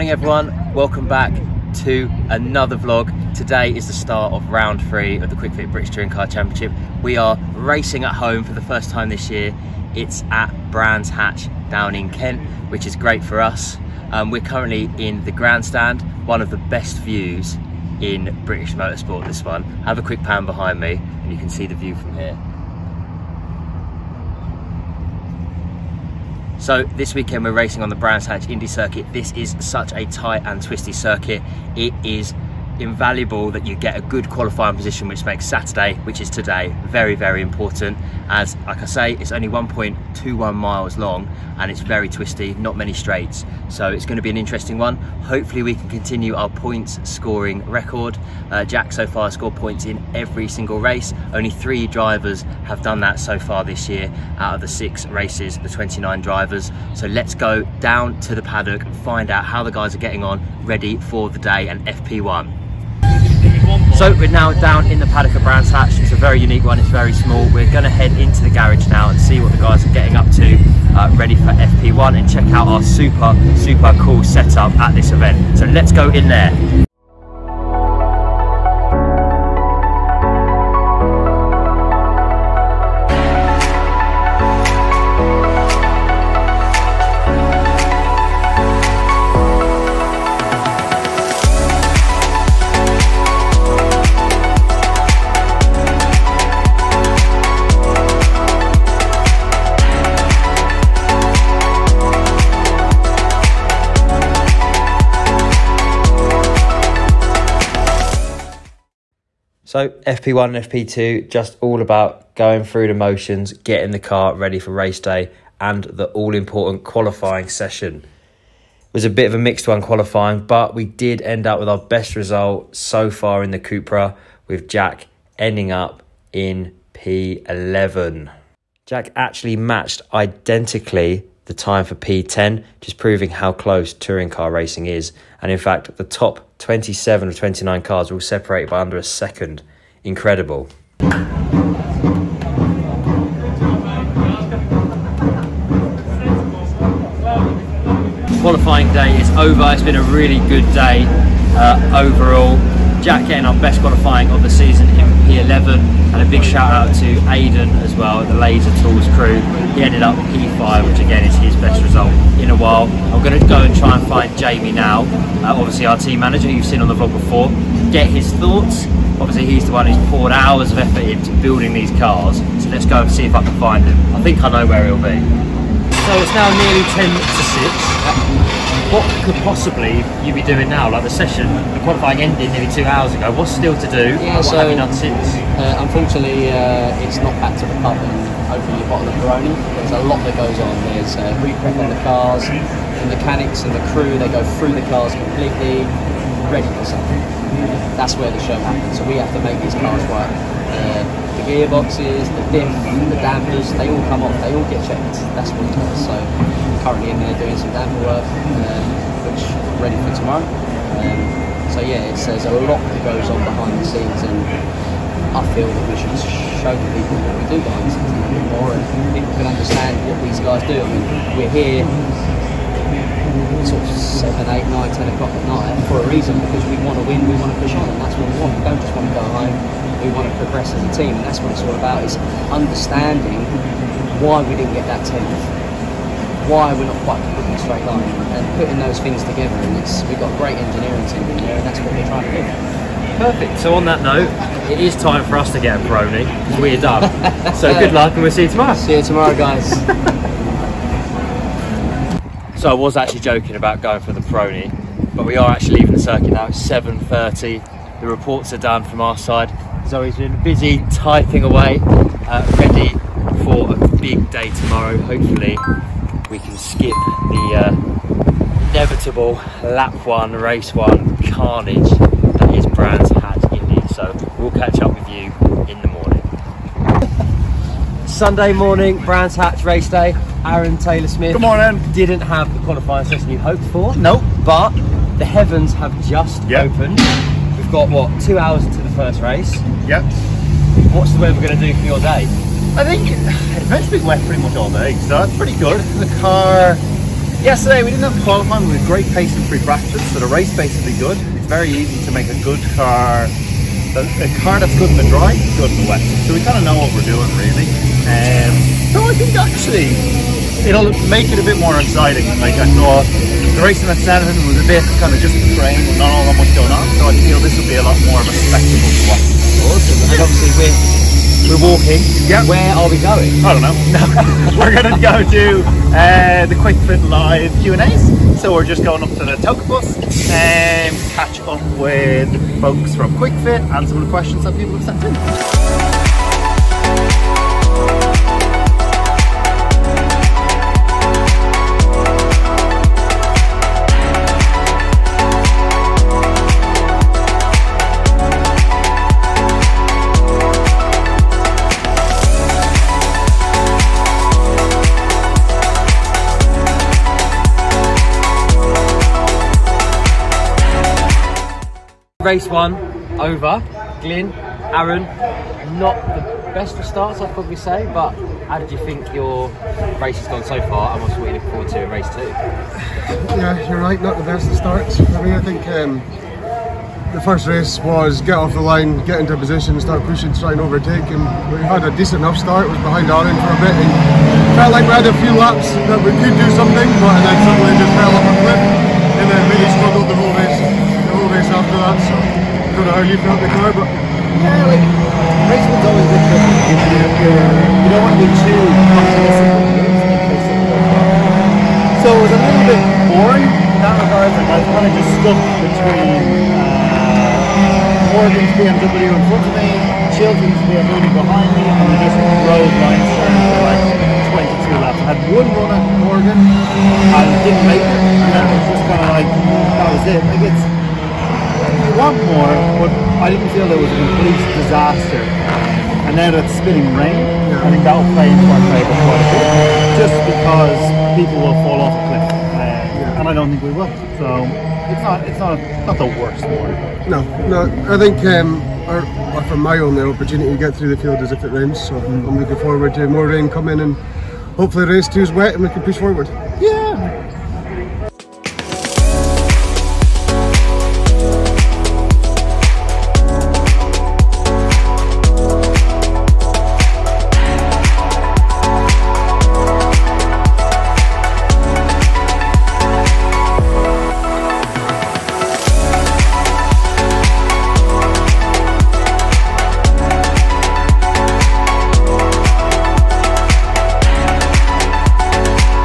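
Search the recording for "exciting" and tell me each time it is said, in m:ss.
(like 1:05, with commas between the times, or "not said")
5:11.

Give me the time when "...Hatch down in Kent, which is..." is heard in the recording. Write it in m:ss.
0:11.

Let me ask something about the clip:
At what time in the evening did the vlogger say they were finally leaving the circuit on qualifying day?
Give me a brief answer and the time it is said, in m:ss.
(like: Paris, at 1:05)
7.30, at 4:16.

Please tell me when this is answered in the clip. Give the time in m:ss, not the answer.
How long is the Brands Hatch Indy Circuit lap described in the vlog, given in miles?
0:39.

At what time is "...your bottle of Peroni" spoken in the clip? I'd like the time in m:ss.
3:08.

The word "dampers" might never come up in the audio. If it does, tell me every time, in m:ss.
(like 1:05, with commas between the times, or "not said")
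3:23, 3:27.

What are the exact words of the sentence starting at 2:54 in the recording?
I think I know where he'll be.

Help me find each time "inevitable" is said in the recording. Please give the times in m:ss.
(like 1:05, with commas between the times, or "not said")
4:28.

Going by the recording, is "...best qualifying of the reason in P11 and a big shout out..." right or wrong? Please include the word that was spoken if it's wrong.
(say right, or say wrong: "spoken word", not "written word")
wrong: "season", not "reason".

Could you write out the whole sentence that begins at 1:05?
It's a very unique one, it's very small.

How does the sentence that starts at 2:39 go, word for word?
He ended up P5 which again is his best result in a while.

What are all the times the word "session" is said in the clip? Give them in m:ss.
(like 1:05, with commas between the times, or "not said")
1:57, 3:01, 4:43.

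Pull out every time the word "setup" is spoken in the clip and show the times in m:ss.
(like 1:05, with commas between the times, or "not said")
1:14.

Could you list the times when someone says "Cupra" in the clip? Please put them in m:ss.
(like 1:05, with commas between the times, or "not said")
2:03.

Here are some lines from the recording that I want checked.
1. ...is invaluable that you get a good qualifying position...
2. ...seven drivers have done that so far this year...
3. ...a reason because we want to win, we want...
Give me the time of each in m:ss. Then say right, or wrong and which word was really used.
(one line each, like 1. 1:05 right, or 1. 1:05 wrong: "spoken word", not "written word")
1. 0:32 right
2. 0:51 wrong: "three", not "seven"
3. 3:45 right.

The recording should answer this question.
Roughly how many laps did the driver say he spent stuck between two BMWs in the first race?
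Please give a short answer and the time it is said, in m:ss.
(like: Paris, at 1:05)
22, at 6:54.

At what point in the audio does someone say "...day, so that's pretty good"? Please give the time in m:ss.
4:54.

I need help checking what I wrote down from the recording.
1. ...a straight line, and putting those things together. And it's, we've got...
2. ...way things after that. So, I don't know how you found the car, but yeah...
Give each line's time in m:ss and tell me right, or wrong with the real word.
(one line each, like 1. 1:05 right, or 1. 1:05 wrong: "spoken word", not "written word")
1. 3:57 right
2. 6:30 right.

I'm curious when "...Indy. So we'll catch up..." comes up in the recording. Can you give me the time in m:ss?
4:33.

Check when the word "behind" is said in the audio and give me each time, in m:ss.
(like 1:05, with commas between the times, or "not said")
0:20, 3:33, 3:37, 6:22, 6:51.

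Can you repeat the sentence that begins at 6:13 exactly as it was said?
Yeah, you're right, not the best of starts.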